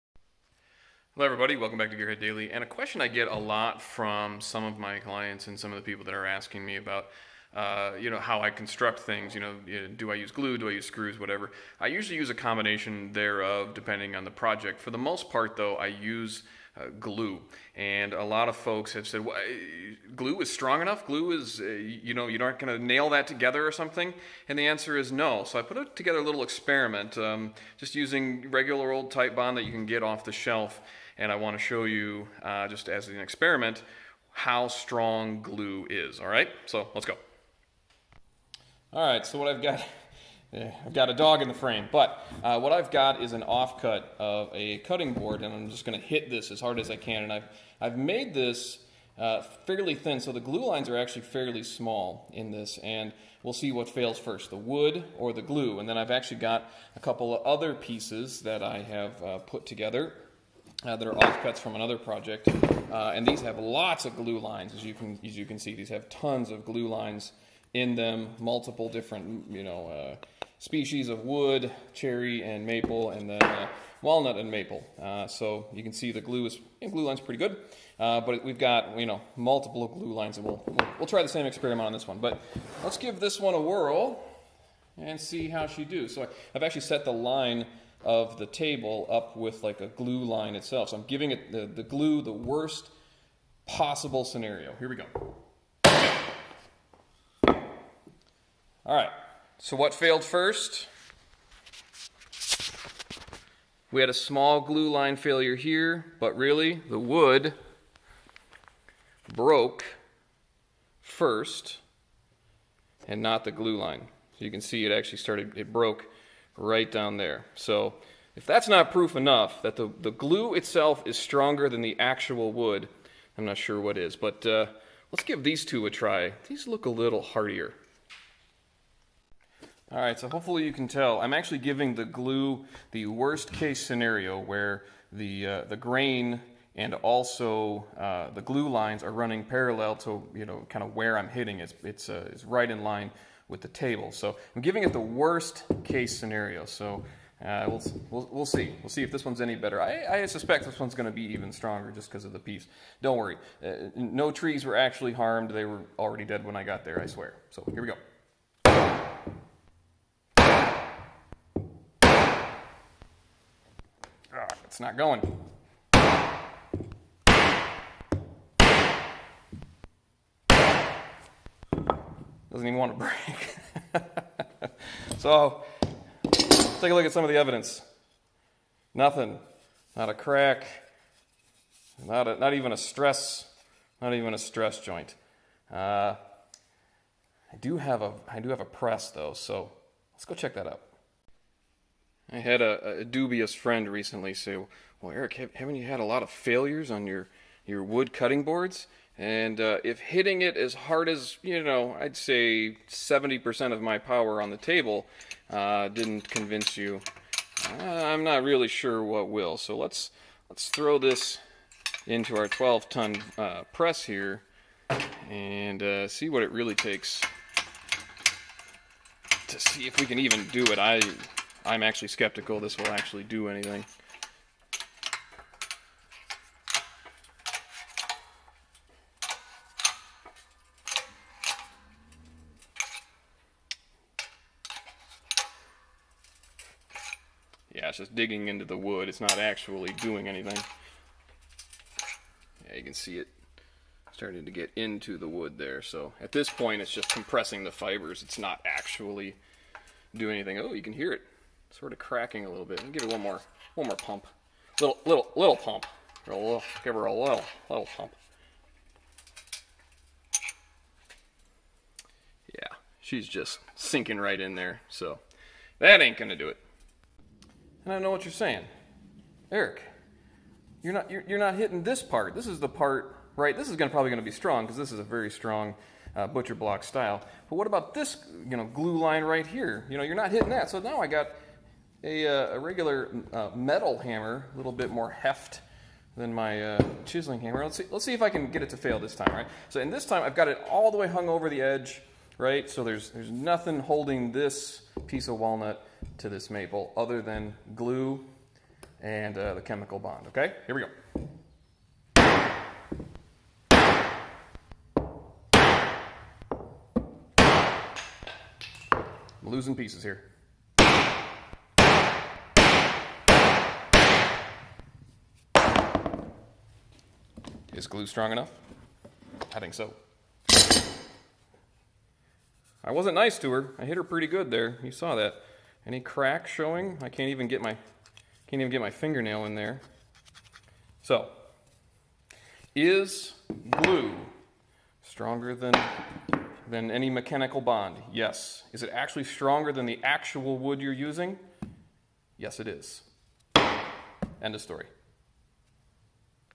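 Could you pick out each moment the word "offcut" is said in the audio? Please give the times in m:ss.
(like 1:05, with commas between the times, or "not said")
0:43, 1:01.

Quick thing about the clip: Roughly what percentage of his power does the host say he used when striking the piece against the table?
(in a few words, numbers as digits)
70%.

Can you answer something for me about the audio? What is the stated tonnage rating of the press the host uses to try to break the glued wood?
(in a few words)
12 ton.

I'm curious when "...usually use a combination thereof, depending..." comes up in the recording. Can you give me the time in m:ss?
0:11.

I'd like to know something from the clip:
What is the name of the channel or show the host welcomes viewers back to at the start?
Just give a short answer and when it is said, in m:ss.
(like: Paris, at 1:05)
Gearhead Daily, at 0:01.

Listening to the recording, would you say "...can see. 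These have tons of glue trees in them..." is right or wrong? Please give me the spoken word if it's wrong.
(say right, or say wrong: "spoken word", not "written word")
wrong: "lines", not "trees".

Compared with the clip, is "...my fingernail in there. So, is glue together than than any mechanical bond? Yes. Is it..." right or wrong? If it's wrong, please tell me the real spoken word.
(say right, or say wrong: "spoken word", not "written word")
wrong: "stronger", not "together".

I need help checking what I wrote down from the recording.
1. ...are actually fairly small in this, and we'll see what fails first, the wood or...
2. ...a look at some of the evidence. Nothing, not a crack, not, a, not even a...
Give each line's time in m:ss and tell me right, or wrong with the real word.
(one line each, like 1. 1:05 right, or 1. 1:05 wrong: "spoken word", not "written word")
1. 0:50 right
2. 2:56 right.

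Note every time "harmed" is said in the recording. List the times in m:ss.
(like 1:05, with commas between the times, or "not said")
2:35.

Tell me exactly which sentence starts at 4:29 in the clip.
Eric, you're not, you're, you're not hitting this part.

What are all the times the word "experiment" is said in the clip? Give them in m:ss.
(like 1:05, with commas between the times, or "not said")
0:26, 0:33, 1:21.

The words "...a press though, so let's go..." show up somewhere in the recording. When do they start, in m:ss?
3:08.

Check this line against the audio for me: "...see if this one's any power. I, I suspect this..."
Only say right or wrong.
wrong.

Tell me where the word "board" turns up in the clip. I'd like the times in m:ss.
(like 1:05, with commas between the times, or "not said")
0:45, 3:18.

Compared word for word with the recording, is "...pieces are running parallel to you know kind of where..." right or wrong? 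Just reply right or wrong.
wrong.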